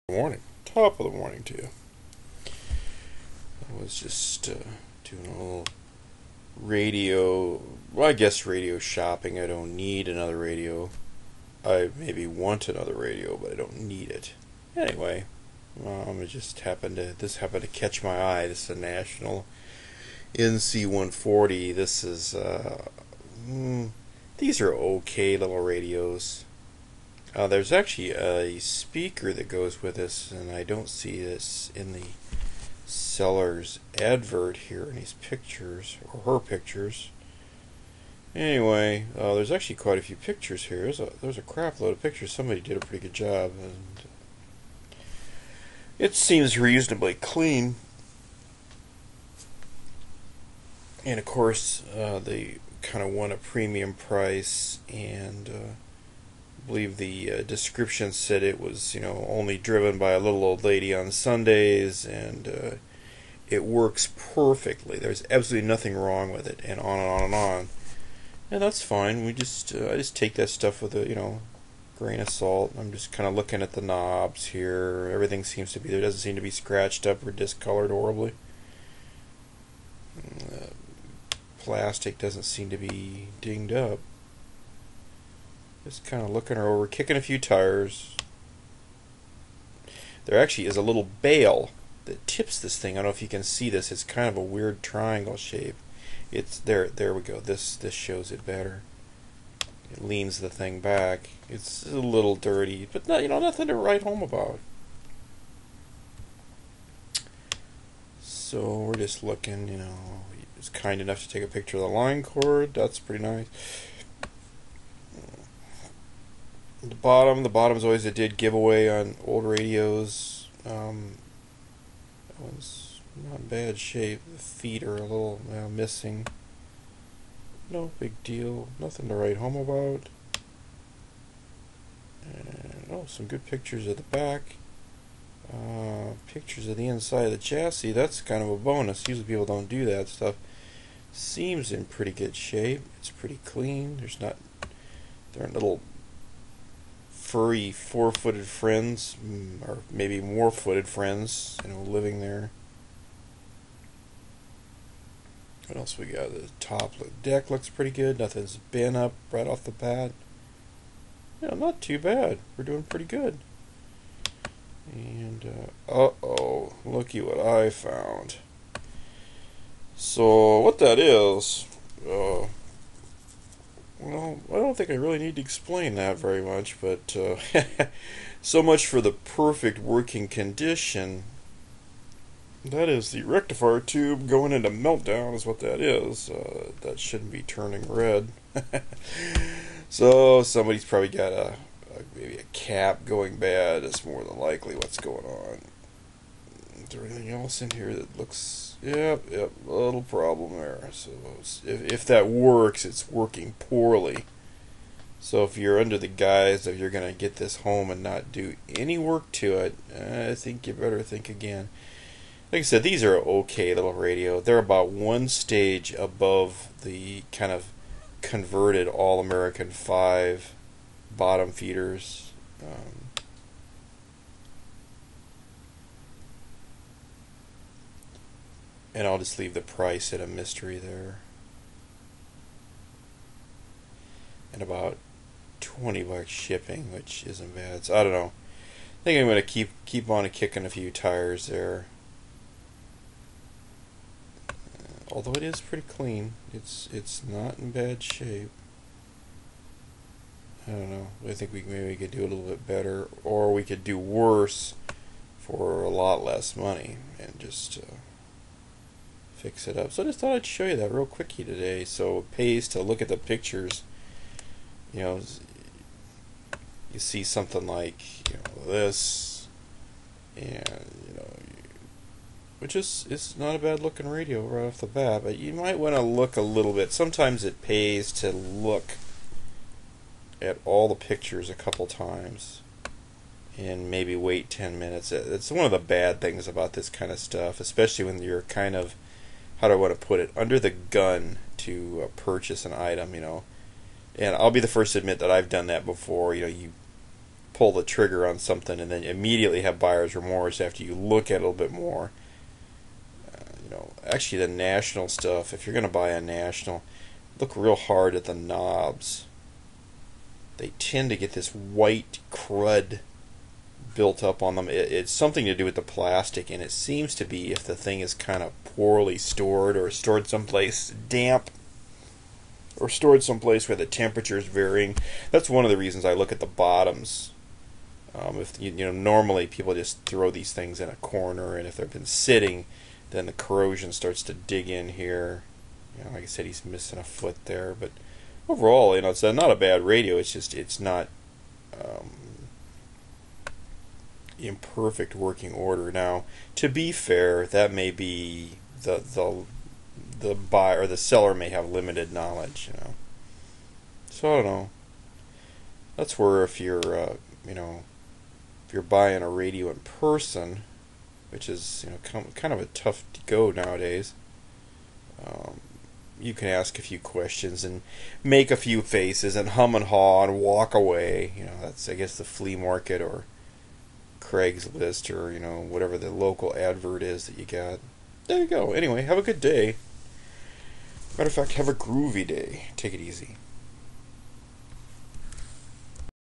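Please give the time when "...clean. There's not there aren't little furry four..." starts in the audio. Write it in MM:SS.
02:23.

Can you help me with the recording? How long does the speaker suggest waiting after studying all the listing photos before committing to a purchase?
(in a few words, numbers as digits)
10 minutes.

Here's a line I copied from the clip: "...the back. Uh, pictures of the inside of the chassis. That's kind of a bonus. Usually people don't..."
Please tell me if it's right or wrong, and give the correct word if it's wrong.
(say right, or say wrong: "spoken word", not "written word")
right.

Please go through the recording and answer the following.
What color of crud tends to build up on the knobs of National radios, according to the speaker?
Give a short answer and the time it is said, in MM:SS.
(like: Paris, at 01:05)
white, at 05:11.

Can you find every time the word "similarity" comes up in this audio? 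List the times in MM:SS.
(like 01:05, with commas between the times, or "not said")
not said.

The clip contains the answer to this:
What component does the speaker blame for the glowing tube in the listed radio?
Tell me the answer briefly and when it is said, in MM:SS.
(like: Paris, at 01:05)
a cap, at 03:12.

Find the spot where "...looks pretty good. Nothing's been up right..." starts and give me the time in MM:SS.
02:37.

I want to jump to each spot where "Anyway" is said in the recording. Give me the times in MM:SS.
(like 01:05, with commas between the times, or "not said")
00:14, 00:38, 06:18.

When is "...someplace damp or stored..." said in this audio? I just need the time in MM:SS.
05:20.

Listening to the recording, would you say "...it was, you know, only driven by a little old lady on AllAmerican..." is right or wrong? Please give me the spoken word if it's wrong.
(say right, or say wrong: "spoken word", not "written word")
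wrong: "Sundays", not "AllAmerican".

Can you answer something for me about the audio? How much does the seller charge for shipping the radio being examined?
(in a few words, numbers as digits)
$20.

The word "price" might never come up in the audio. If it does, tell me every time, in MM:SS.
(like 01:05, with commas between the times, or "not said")
00:53, 03:49.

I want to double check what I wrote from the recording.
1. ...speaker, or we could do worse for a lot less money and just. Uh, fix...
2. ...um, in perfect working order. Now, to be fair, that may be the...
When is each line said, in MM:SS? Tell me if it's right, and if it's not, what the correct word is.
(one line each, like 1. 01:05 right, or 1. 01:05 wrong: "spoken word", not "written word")
1. 04:12 wrong: "better", not "speaker"
2. 05:41 right.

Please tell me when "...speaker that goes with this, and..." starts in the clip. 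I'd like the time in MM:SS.
00:28.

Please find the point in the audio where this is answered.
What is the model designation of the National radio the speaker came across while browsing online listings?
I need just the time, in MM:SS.
00:20.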